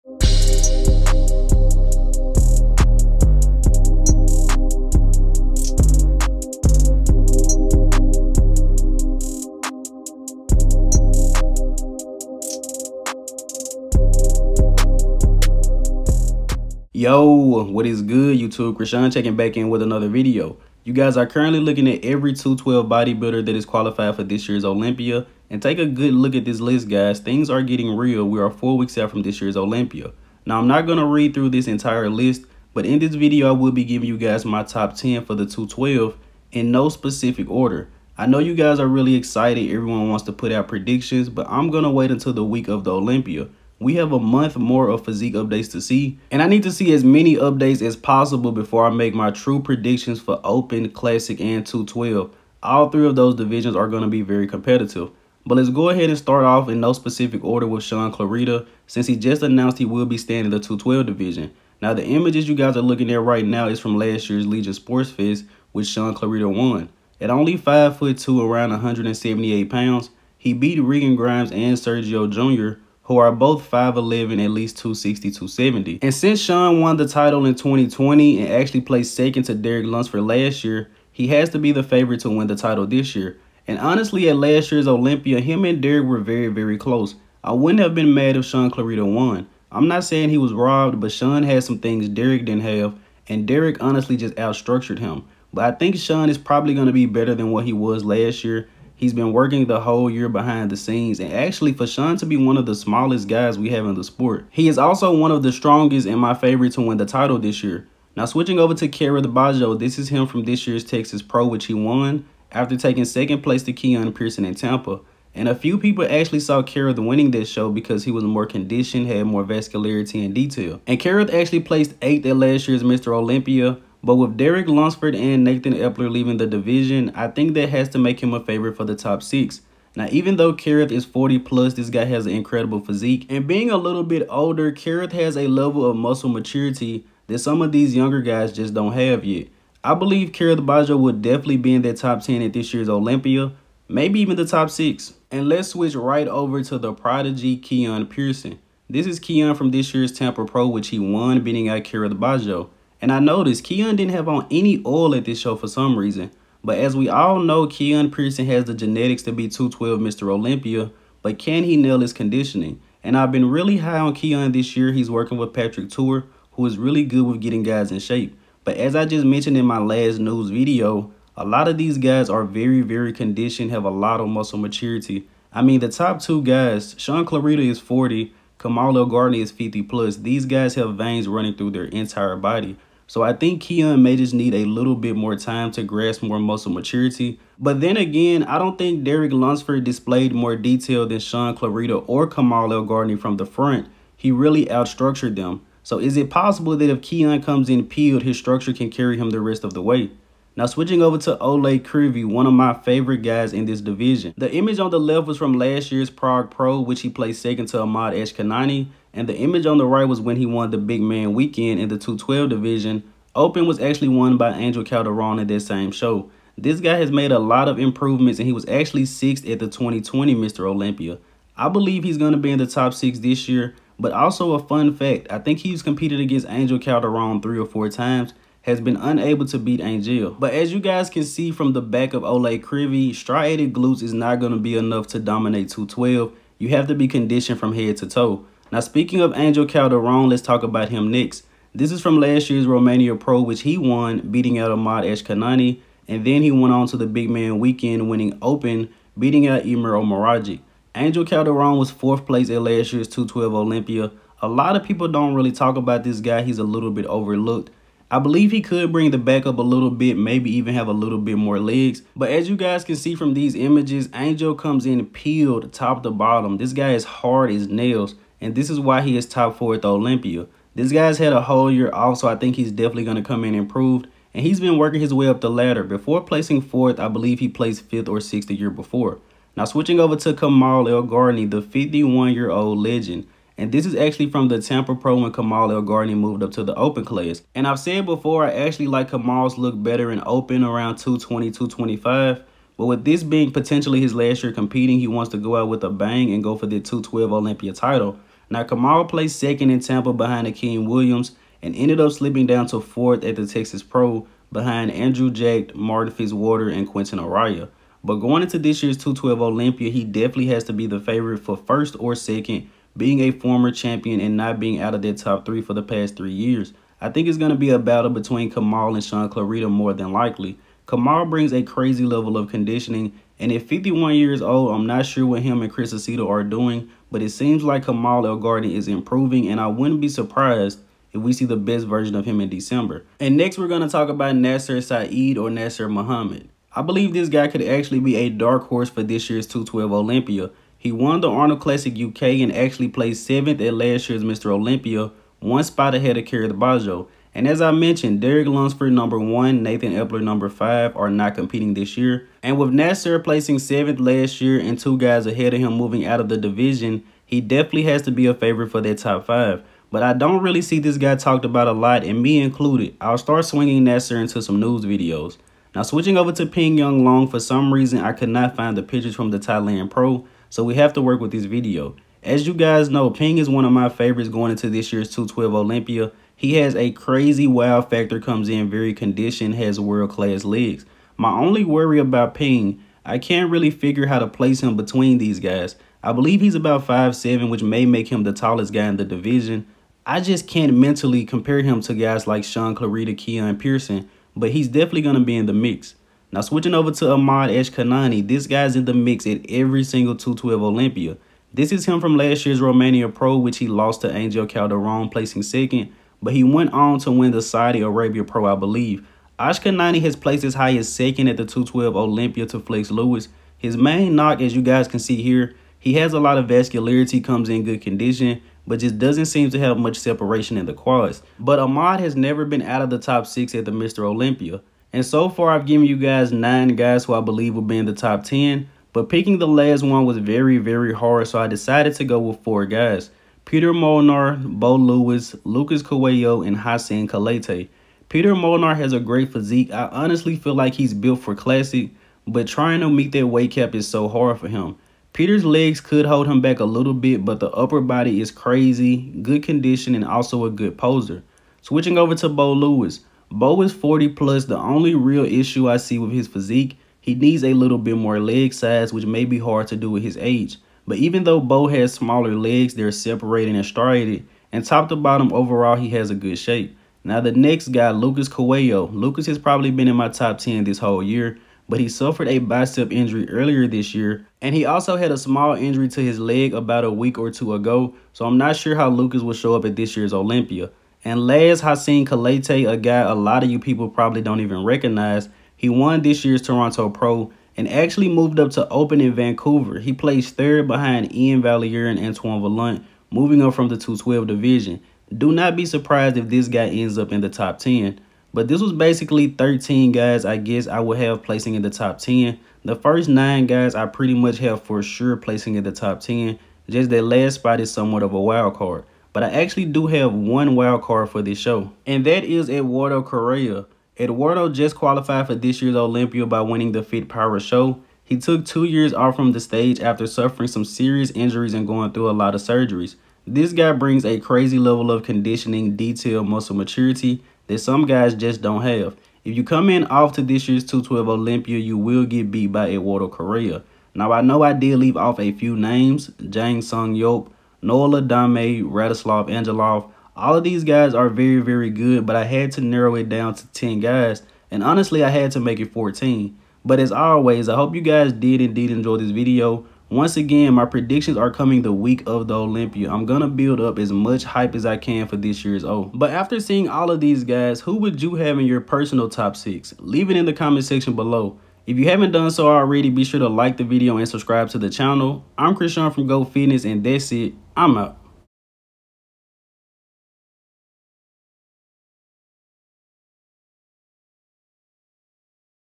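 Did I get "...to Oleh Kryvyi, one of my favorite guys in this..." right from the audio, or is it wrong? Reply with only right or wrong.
right.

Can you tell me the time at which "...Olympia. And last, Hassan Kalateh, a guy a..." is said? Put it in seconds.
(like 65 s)
480 s.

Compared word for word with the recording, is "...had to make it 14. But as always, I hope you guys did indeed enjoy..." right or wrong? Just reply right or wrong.
right.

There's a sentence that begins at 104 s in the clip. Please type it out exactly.
He is also one of the strongest and my favorite to win the title this year.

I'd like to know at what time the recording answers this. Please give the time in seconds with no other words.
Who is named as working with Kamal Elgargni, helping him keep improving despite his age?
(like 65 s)
325 s.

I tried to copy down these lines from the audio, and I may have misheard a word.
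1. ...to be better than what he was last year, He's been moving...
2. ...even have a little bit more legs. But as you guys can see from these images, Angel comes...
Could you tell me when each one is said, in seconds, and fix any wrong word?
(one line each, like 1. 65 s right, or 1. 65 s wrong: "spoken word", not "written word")
1. 96 s wrong: "working", not "moving"
2. 260 s right.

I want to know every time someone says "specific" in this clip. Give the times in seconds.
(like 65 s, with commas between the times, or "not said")
36 s, 56 s.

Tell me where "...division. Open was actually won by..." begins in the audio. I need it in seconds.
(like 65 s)
212 s.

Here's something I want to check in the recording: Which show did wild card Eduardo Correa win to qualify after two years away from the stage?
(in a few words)
Fit Power Show.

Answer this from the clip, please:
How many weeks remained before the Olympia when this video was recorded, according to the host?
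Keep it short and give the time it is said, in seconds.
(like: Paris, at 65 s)
4, at 28 s.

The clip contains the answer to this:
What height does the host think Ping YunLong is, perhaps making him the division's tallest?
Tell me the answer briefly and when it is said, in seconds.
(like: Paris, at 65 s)
5'7", at 386 s.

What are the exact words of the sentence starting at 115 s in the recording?
And a few people actually saw Kerrith winning this show because he was more conditioned, had more vascularity and detail.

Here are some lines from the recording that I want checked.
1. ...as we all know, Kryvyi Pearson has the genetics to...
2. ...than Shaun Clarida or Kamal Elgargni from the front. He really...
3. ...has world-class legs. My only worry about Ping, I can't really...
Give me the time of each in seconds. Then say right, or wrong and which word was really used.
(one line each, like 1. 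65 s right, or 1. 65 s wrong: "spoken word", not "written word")
1. 156 s wrong: "Keone", not "Kryvyi"
2. 191 s right
3. 379 s right.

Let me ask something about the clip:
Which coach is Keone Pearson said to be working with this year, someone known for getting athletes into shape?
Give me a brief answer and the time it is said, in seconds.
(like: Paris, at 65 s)
Patrick Tuor, at 165 s.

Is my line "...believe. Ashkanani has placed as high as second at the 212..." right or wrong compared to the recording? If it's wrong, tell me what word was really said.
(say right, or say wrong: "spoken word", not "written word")
right.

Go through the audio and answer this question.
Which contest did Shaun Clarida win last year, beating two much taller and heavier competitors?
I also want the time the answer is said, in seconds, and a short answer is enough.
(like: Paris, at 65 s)
Legion Sports Fest, at 64 s.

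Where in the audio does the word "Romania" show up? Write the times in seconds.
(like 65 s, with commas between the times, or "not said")
242 s, 402 s.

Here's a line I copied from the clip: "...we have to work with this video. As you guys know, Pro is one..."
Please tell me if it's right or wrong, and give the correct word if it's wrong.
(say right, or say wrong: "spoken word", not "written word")
wrong: "Ping", not "Pro".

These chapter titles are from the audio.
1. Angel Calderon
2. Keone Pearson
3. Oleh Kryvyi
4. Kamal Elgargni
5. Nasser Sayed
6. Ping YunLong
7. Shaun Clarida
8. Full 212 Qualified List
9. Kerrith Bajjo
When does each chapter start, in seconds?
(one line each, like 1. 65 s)
1. 241 s
2. 149 s
3. 200 s
4. 282 s
5. 335 s
6. 367 s
7. 58 s
8. 18 s
9. 110 s.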